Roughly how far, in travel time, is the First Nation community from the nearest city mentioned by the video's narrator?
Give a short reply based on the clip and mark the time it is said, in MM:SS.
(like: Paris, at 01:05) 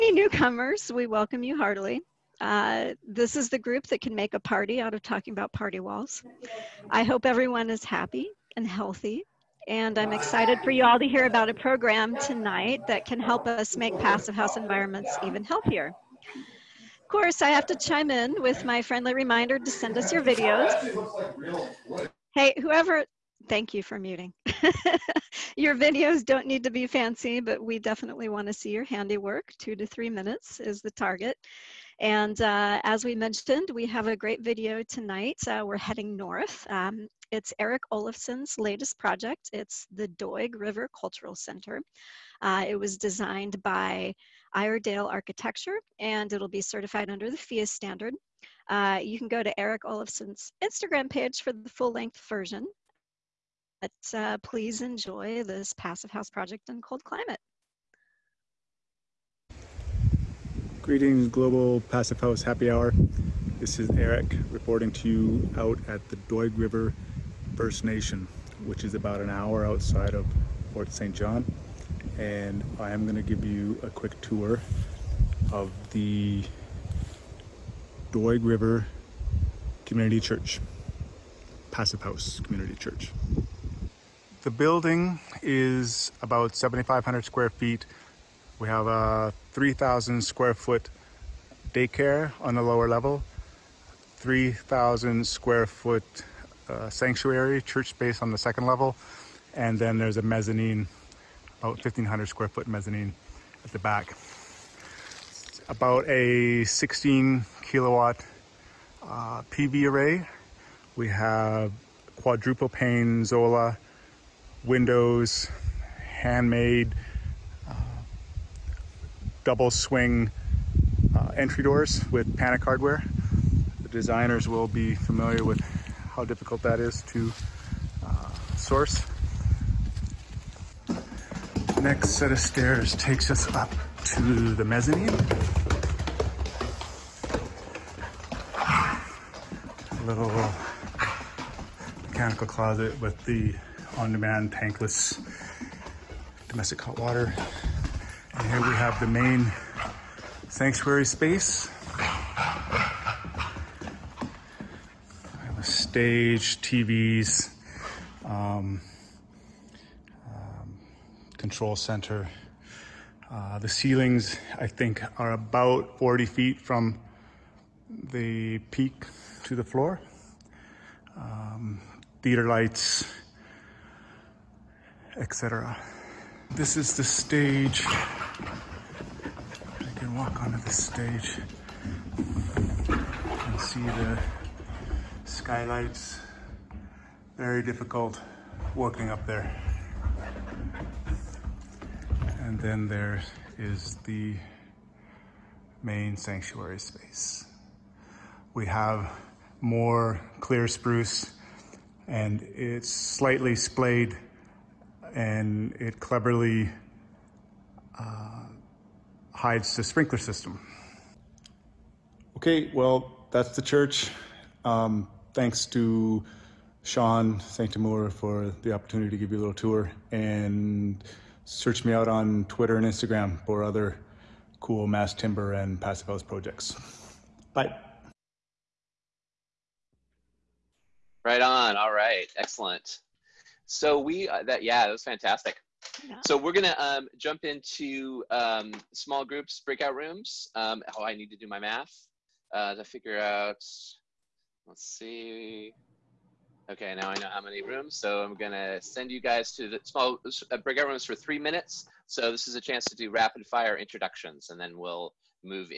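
About an hour, at 01:08.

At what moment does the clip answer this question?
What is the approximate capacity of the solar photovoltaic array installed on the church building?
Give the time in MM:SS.
01:46.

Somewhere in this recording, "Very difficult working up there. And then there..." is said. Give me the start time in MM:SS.
03:07.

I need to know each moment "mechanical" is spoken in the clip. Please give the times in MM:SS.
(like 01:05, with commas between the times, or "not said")
02:22.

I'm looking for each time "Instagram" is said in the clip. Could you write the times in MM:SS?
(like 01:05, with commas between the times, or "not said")
00:50, 03:42.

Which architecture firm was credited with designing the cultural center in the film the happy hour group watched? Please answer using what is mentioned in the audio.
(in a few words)
Iredale Architecture.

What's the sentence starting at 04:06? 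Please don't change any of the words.
Okay, now I know how many rooms, so I'm gonna send you guys to the small uh, breakout rooms for three minutes.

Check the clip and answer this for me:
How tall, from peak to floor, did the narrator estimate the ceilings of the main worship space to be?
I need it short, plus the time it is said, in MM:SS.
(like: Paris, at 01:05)
About 40 feet, at 02:45.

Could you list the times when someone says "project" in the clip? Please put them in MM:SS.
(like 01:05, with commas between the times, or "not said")
00:38, 00:56, 03:46.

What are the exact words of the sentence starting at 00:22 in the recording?
Hey, whoever, thank you for muting.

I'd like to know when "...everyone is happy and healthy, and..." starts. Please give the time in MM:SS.
00:07.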